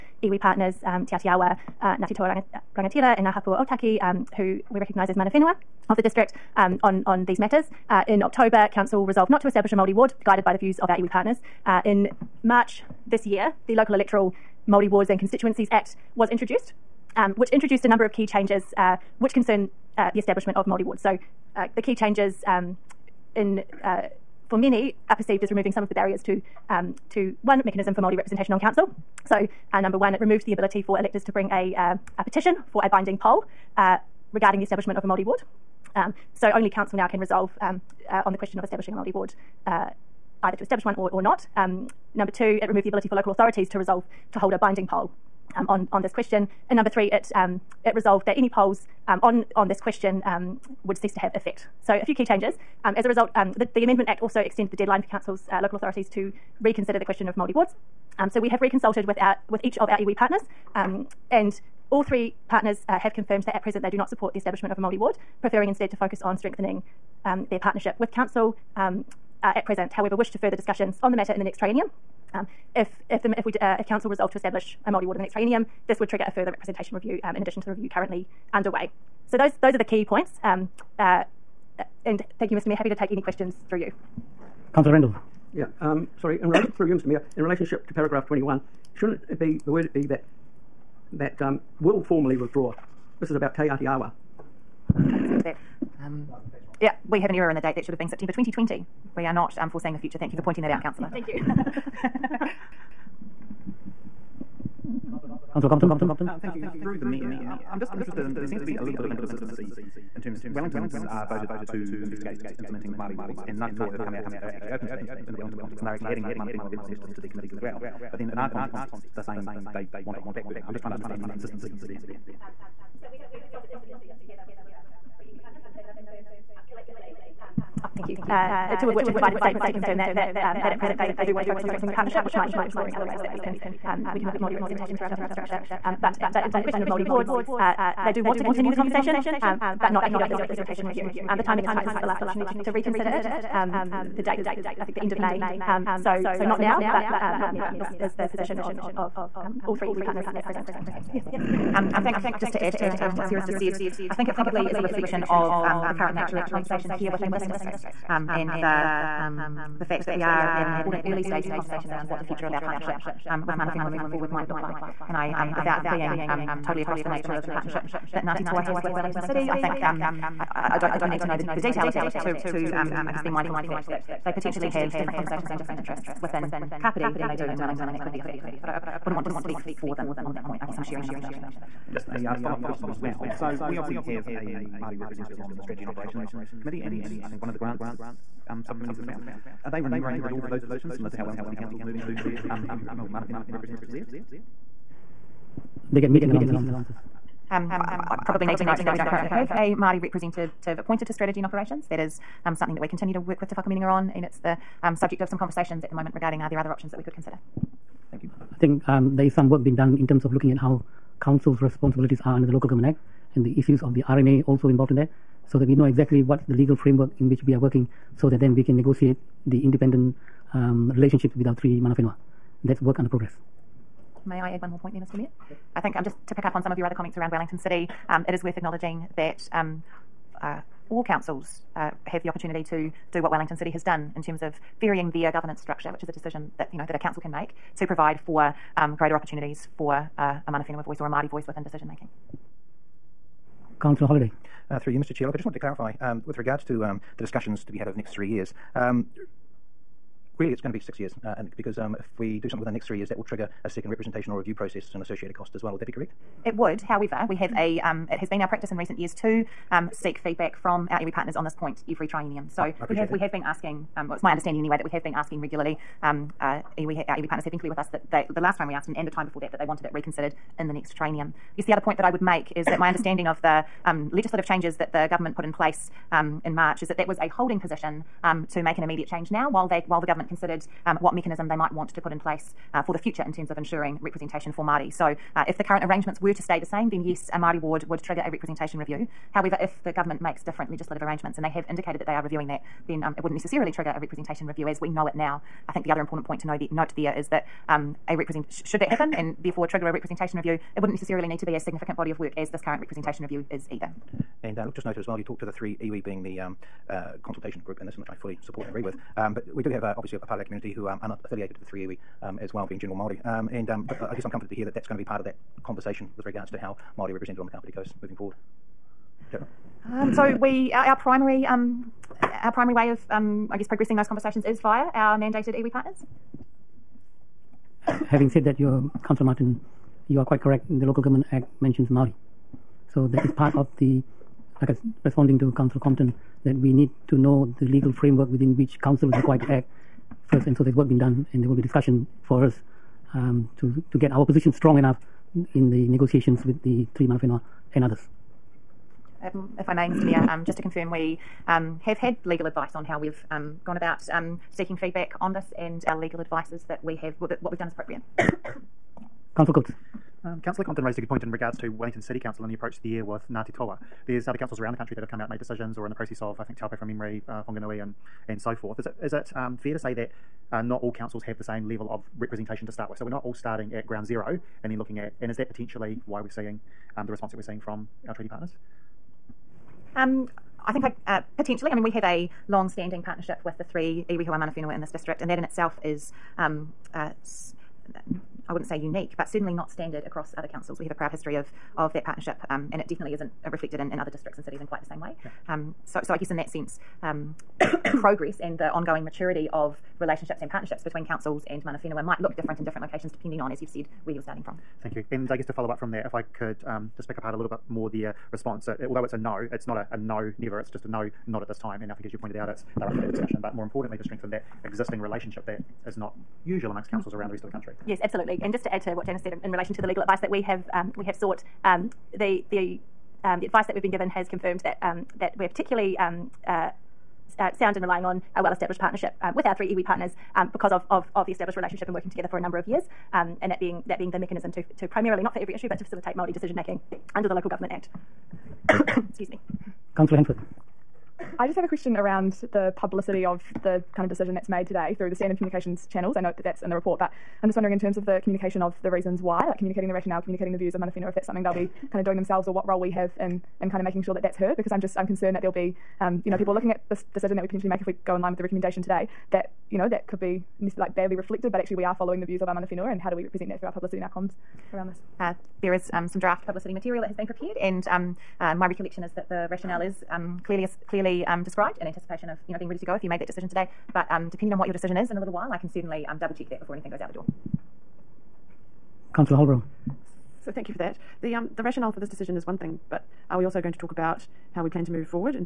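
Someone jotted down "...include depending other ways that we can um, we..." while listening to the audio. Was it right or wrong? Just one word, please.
wrong.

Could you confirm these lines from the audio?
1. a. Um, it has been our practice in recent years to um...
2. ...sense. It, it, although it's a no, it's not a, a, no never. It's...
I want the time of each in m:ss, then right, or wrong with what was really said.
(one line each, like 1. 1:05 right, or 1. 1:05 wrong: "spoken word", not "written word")
1. 4:17 right
2. 6:48 wrong: "response", not "sense".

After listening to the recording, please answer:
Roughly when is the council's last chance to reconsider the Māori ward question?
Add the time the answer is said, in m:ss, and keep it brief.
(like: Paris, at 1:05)
End of May, at 2:24.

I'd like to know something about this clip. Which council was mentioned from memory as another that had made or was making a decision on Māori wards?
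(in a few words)
Taupo.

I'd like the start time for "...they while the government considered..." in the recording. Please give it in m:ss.
4:39.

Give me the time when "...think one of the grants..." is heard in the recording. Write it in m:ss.
3:07.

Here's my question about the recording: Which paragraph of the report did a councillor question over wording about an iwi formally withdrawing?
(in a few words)
21.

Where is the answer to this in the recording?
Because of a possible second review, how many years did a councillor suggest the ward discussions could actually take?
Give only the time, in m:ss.
4:10.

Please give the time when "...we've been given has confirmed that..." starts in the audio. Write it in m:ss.
7:03.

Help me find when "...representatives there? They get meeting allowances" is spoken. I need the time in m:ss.
3:13.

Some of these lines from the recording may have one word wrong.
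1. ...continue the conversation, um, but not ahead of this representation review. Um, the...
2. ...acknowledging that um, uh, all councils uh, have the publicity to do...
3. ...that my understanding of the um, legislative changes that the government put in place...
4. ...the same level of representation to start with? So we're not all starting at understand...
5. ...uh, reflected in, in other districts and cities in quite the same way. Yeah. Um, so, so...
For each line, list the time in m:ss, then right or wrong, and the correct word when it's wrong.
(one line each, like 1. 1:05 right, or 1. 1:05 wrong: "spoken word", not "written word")
1. 2:18 right
2. 3:48 wrong: "opportunity", not "publicity"
3. 4:32 right
4. 6:11 wrong: "ground", not "understand"
5. 6:33 right.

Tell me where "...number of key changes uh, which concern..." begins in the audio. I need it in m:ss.
0:17.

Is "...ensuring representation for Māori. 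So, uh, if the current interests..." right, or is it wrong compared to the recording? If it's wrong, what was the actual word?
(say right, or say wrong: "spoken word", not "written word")
wrong: "arrangements", not "interests".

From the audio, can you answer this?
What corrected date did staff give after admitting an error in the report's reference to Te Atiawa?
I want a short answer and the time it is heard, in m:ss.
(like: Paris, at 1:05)
September 2020, at 1:38.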